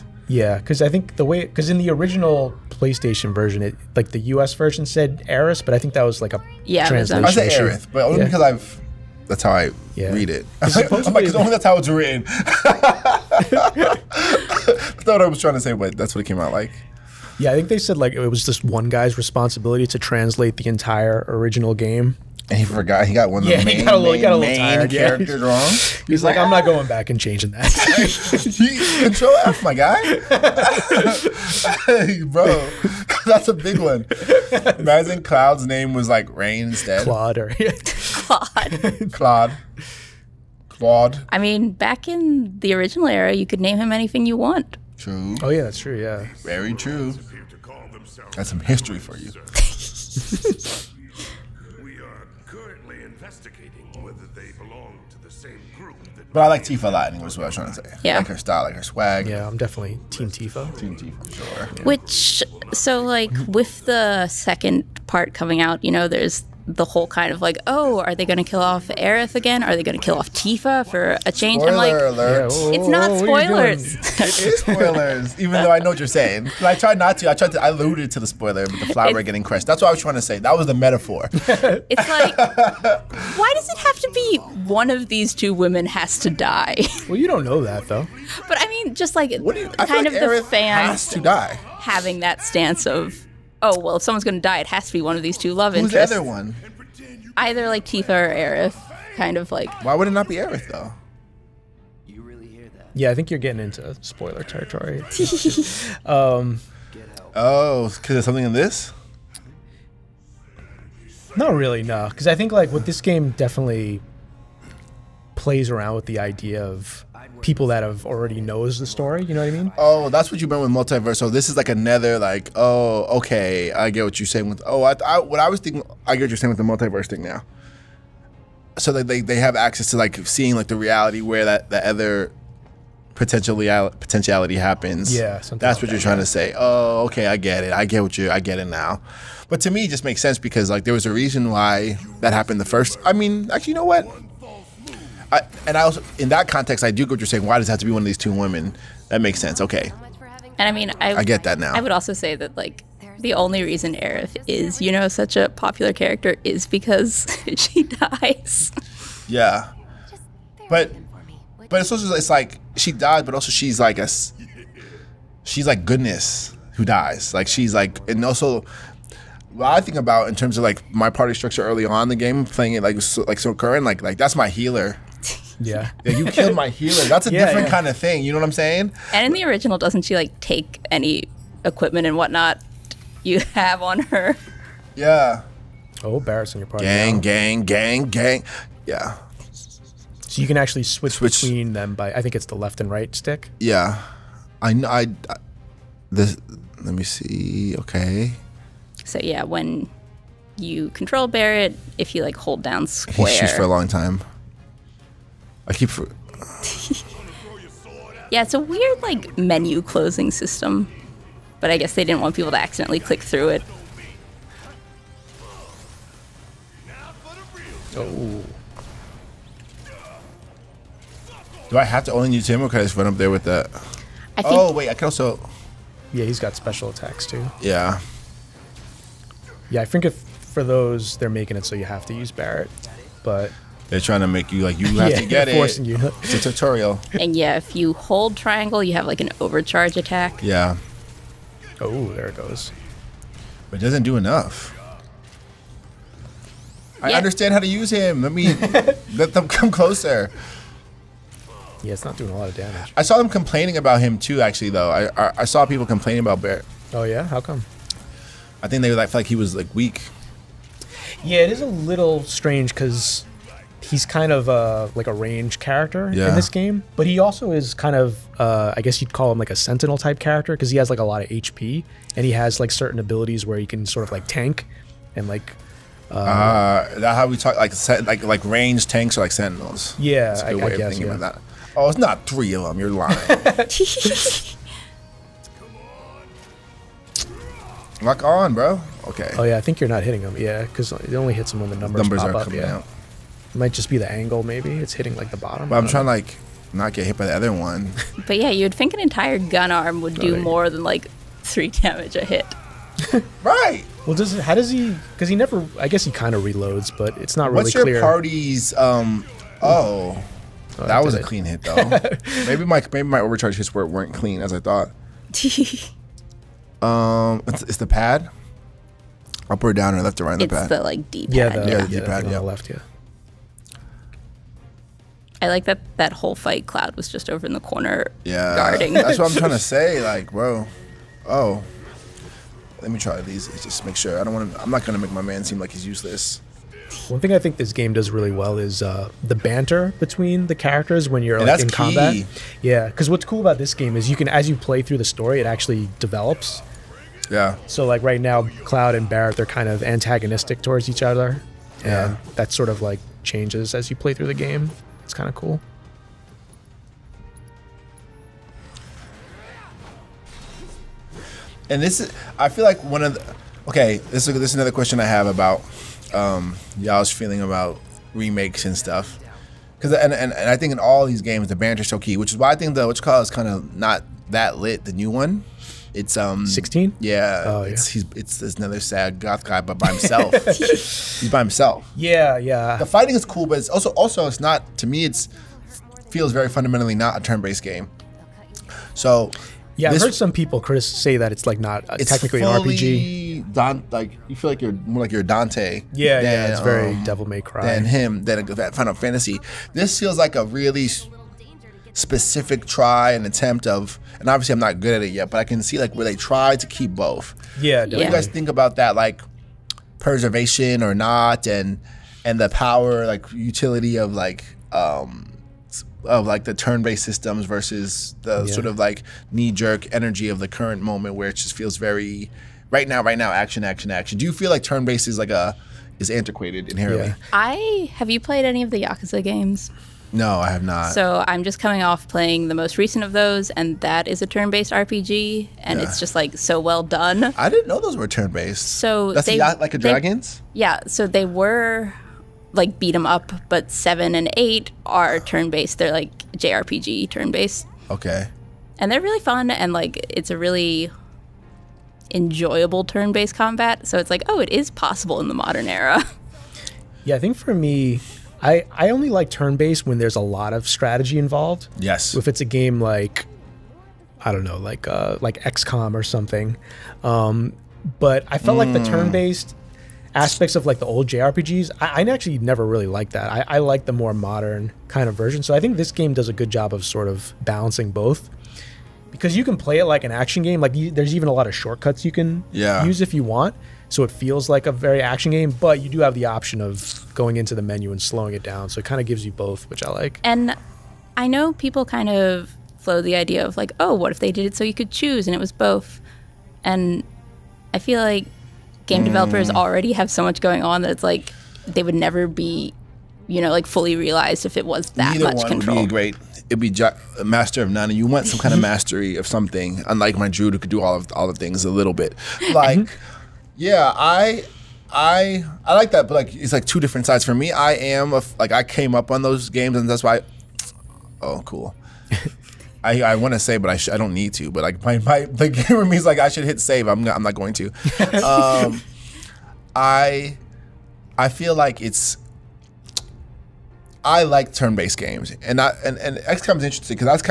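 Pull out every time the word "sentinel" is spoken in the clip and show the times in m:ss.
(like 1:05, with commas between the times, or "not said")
4:29, 4:39.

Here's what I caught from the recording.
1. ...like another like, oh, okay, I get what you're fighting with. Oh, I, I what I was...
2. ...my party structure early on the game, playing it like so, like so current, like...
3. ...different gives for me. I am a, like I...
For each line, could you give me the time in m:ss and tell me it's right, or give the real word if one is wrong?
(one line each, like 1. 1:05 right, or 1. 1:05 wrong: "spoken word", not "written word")
1. 2:01 wrong: "saying", not "fighting"
2. 2:50 right
3. 8:36 wrong: "sides", not "gives".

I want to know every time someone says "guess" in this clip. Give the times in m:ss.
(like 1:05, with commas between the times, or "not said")
3:31, 4:28, 5:05.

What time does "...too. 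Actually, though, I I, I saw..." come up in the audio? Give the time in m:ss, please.
4:14.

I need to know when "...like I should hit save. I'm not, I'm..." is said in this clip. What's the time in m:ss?
8:46.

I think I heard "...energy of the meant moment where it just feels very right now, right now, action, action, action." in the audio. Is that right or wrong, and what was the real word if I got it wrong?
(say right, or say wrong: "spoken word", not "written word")
wrong: "current", not "meant".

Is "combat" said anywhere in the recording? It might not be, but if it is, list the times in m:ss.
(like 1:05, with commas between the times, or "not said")
5:41, 7:33.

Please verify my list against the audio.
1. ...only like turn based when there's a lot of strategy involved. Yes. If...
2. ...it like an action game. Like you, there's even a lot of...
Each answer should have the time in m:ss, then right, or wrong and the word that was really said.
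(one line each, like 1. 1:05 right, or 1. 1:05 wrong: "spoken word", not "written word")
1. 7:38 right
2. 7:59 right.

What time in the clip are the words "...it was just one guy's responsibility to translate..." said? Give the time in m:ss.
0:18.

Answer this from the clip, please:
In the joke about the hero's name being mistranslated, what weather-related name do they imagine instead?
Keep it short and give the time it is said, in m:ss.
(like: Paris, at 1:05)
Rain, at 0:36.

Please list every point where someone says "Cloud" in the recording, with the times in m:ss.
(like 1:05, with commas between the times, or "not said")
0:35, 5:26, 5:48.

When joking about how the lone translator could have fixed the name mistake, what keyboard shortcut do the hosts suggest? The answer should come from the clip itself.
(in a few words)
Control F.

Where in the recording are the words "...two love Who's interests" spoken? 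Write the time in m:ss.
1:35.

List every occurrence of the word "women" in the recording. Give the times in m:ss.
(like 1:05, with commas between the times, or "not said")
1:25, 2:28.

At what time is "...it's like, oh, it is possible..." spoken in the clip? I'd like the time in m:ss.
7:33.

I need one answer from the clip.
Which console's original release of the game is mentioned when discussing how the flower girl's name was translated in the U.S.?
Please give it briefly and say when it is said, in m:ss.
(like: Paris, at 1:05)
PlayStation, at 0:02.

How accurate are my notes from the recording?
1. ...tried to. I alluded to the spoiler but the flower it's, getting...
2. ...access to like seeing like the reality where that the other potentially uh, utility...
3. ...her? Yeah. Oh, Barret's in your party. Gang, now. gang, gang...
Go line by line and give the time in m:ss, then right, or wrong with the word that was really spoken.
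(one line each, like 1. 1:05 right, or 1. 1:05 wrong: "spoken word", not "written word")
1. 1:17 right
2. 2:09 wrong: "potentiality", not "utility"
3. 3:04 right.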